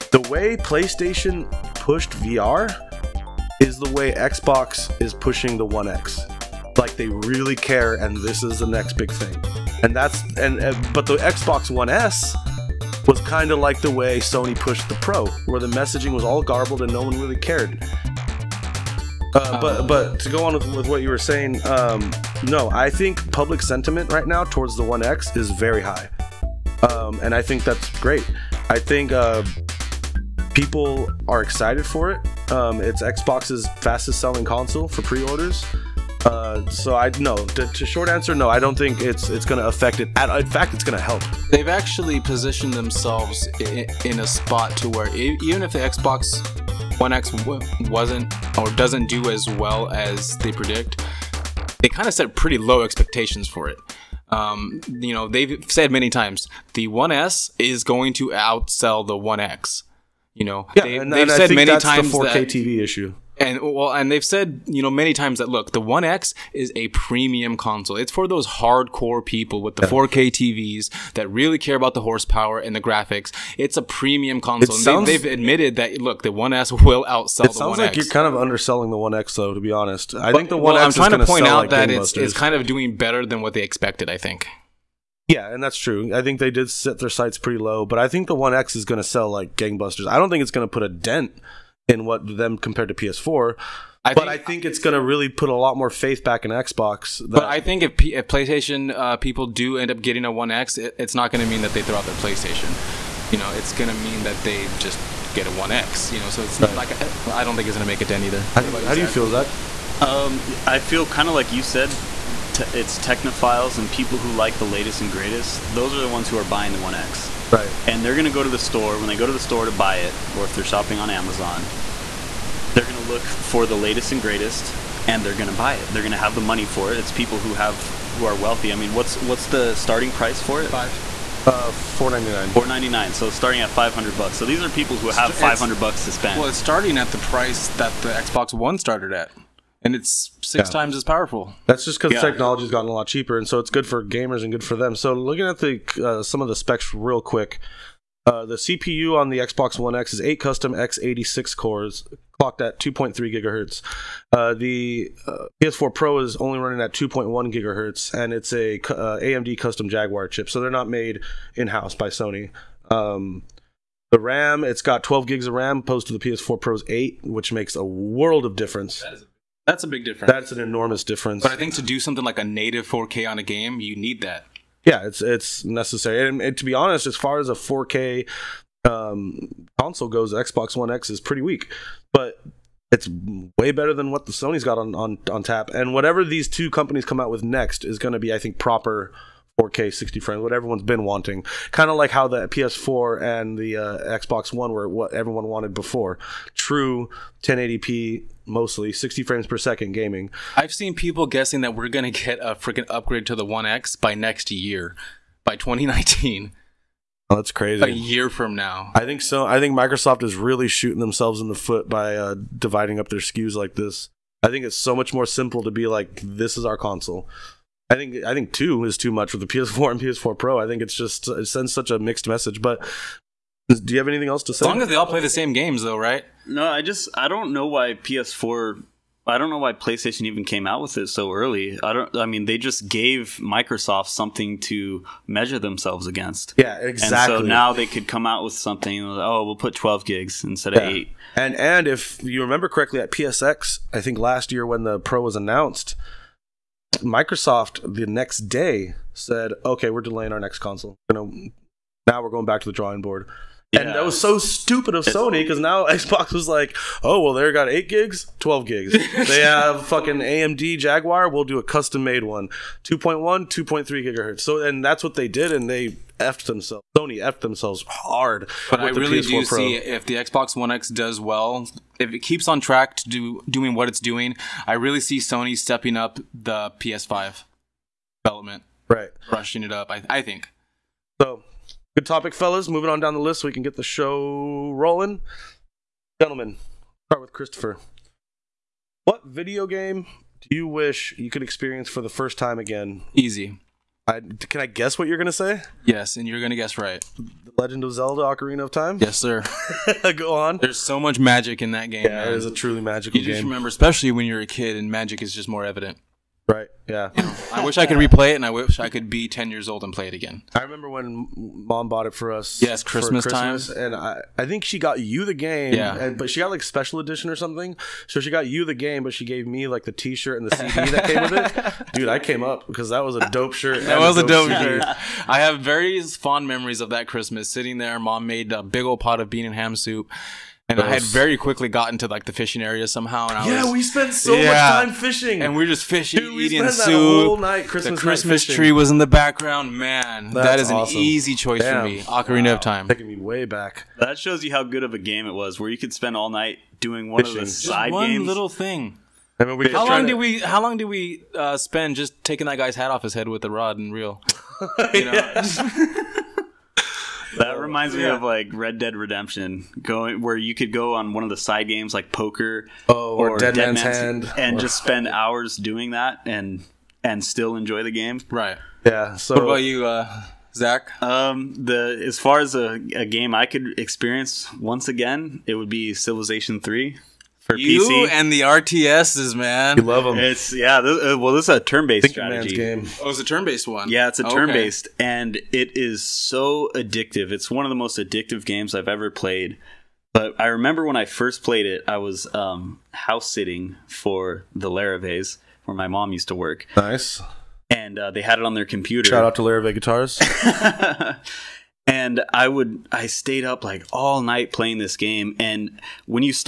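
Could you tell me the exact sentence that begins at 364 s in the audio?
just spend hours doing that and and still enjoy the game.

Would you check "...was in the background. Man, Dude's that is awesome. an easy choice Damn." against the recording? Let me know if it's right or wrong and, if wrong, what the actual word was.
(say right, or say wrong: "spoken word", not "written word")
wrong: "That", not "Dude".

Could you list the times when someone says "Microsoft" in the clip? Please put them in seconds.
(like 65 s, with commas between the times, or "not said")
209 s, 233 s, 246 s.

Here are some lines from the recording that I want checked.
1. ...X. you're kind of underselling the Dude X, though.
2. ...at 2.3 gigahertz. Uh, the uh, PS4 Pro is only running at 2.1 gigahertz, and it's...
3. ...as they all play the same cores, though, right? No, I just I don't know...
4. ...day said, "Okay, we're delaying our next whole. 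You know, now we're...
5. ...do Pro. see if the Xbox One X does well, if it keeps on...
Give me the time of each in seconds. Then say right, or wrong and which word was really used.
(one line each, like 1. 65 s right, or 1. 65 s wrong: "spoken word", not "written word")
1. 77 s wrong: "One", not "Dude"
2. 152 s right
3. 224 s wrong: "games", not "cores"
4. 248 s wrong: "console", not "whole"
5. 269 s right.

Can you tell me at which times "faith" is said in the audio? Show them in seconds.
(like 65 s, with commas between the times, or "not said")
95 s.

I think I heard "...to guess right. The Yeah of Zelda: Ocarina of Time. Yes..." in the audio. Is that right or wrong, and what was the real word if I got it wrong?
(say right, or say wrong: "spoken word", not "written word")
wrong: "Legend", not "Yeah".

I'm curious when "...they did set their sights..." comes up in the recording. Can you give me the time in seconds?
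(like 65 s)
86 s.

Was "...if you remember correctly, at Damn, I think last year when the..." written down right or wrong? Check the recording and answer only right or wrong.
wrong.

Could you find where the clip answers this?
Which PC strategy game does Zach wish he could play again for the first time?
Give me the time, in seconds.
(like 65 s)
375 s.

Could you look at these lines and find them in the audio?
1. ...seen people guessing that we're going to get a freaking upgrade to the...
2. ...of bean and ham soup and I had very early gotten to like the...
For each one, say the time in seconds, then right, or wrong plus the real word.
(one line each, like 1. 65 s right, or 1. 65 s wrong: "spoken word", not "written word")
1. 200 s right
2. 329 s wrong: "quickly", not "early".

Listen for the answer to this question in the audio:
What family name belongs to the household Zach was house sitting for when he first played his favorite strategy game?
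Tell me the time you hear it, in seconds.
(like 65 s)
394 s.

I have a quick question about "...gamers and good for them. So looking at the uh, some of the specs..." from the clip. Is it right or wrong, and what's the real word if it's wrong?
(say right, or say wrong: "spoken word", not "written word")
right.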